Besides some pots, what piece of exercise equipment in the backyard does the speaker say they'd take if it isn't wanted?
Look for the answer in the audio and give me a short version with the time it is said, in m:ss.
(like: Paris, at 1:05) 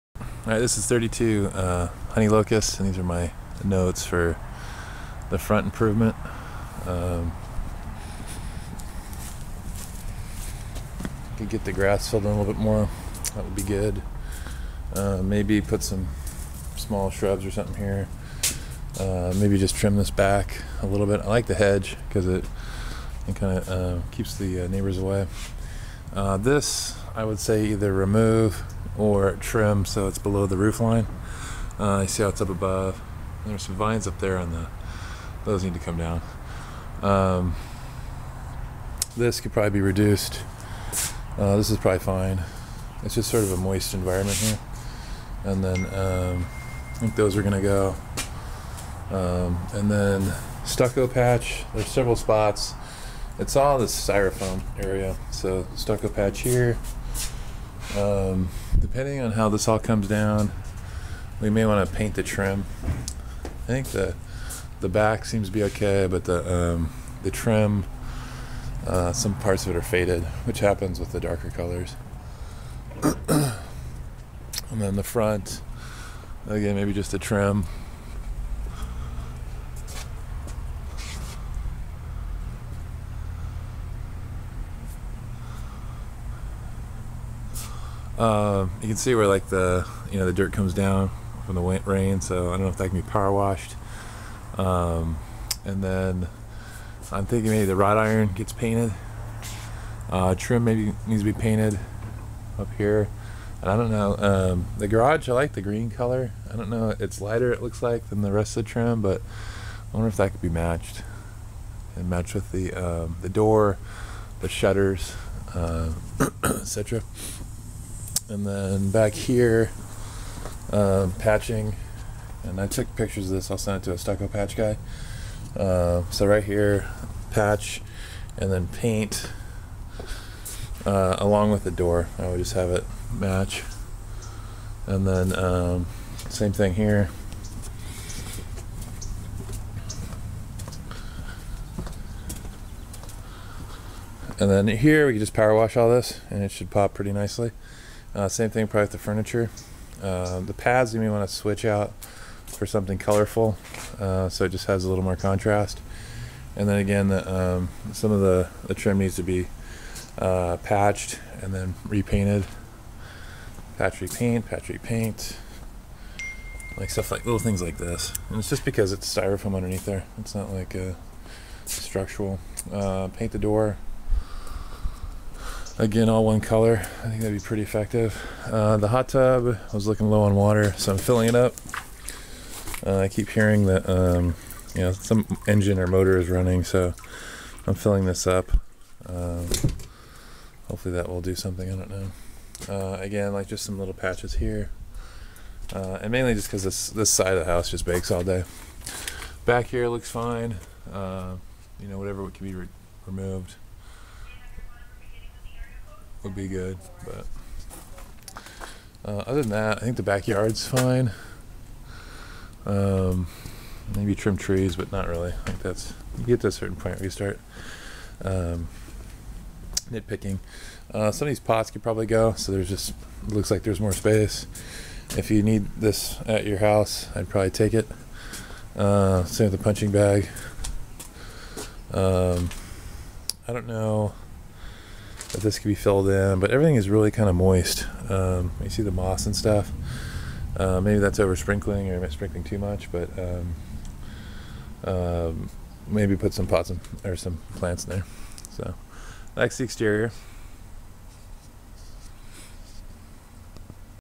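Punching bag, at 3:49.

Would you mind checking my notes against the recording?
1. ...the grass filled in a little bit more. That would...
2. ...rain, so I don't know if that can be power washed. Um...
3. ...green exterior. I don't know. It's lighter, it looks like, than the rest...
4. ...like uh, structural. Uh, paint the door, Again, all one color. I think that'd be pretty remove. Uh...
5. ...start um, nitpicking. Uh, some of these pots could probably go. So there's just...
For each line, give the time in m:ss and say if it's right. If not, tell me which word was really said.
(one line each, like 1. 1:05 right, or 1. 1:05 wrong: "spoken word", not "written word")
1. 0:11 right
2. 1:31 right
3. 1:45 wrong: "color", not "exterior"
4. 2:50 wrong: "effective", not "remove"
5. 3:37 right.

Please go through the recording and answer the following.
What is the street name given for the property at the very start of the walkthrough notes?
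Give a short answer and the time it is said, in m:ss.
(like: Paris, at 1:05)
Honey Locusts, at 0:02.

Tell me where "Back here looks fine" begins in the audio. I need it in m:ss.
3:19.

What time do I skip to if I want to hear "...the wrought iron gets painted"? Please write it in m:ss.
1:37.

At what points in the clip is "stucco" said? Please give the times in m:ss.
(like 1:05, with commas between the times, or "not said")
0:50, 0:55, 2:03.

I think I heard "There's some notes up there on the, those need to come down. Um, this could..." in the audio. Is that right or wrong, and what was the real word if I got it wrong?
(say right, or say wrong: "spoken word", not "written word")
wrong: "vines", not "notes".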